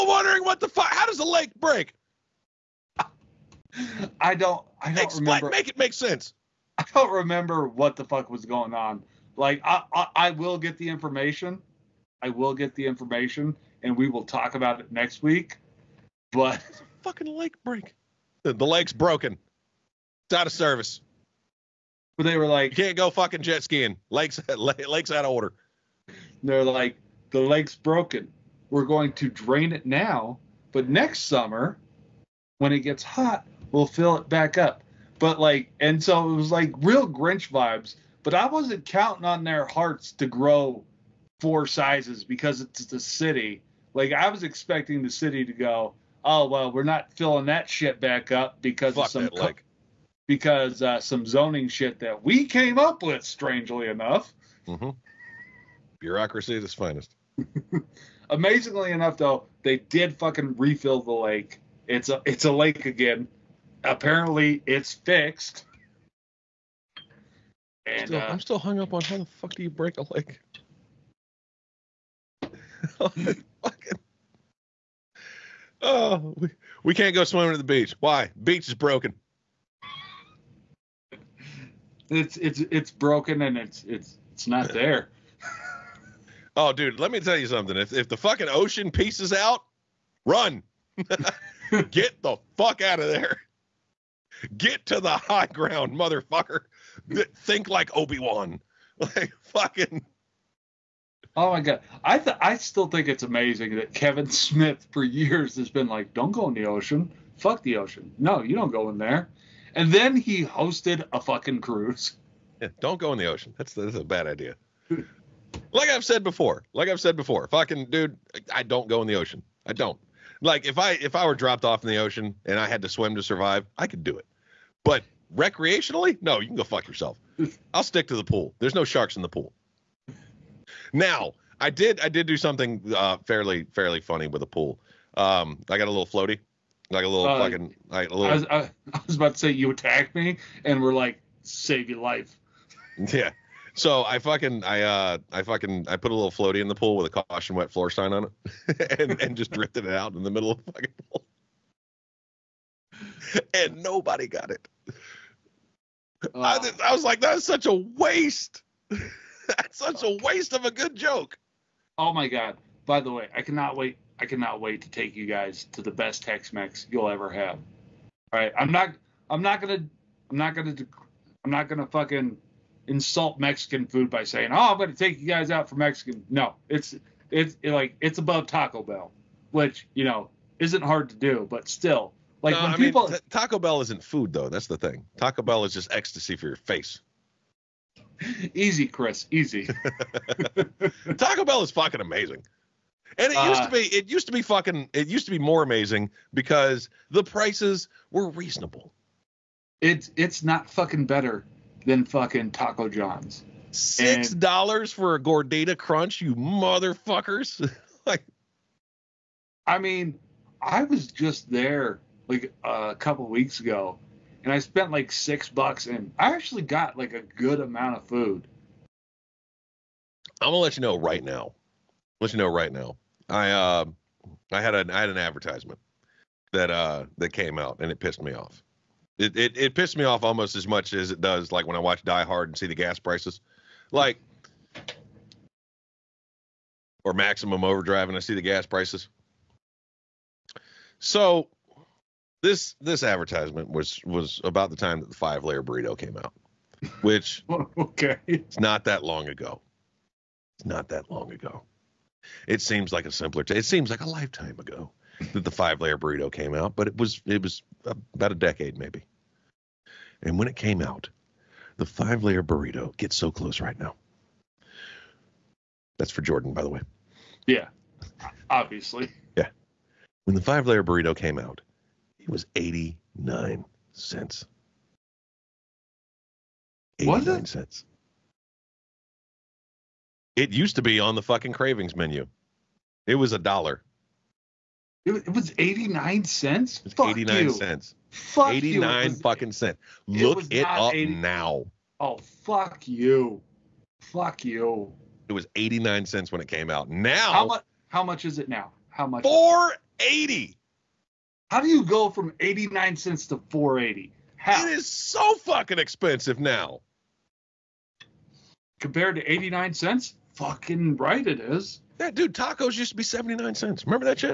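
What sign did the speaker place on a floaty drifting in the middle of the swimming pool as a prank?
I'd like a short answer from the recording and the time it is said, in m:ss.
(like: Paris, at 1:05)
caution wet floor, at 2:27.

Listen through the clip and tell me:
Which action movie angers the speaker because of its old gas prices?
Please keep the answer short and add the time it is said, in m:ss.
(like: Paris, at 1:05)
Die Hard, at 3:52.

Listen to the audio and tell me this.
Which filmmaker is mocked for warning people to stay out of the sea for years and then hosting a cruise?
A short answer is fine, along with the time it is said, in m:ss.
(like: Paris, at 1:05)
Kevin Smith, at 1:43.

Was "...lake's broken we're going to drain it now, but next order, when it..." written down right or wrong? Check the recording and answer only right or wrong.
wrong.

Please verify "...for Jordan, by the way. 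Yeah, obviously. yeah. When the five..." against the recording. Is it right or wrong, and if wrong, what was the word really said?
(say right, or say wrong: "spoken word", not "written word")
right.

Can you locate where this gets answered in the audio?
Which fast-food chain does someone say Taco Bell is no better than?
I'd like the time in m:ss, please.
3:22.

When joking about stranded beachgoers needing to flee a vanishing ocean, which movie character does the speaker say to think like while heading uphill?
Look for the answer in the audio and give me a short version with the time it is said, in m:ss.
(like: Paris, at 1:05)
Obi Wan, at 1:37.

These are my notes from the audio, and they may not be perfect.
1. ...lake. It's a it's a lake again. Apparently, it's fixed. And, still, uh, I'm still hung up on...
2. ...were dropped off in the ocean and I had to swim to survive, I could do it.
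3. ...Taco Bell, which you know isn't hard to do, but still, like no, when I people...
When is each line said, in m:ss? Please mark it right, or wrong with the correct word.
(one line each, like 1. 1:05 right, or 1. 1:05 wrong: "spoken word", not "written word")
1. 1:01 right
2. 2:01 right
3. 2:58 right.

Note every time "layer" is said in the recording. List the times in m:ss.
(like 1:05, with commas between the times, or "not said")
4:05, 4:15, 4:22, 4:30.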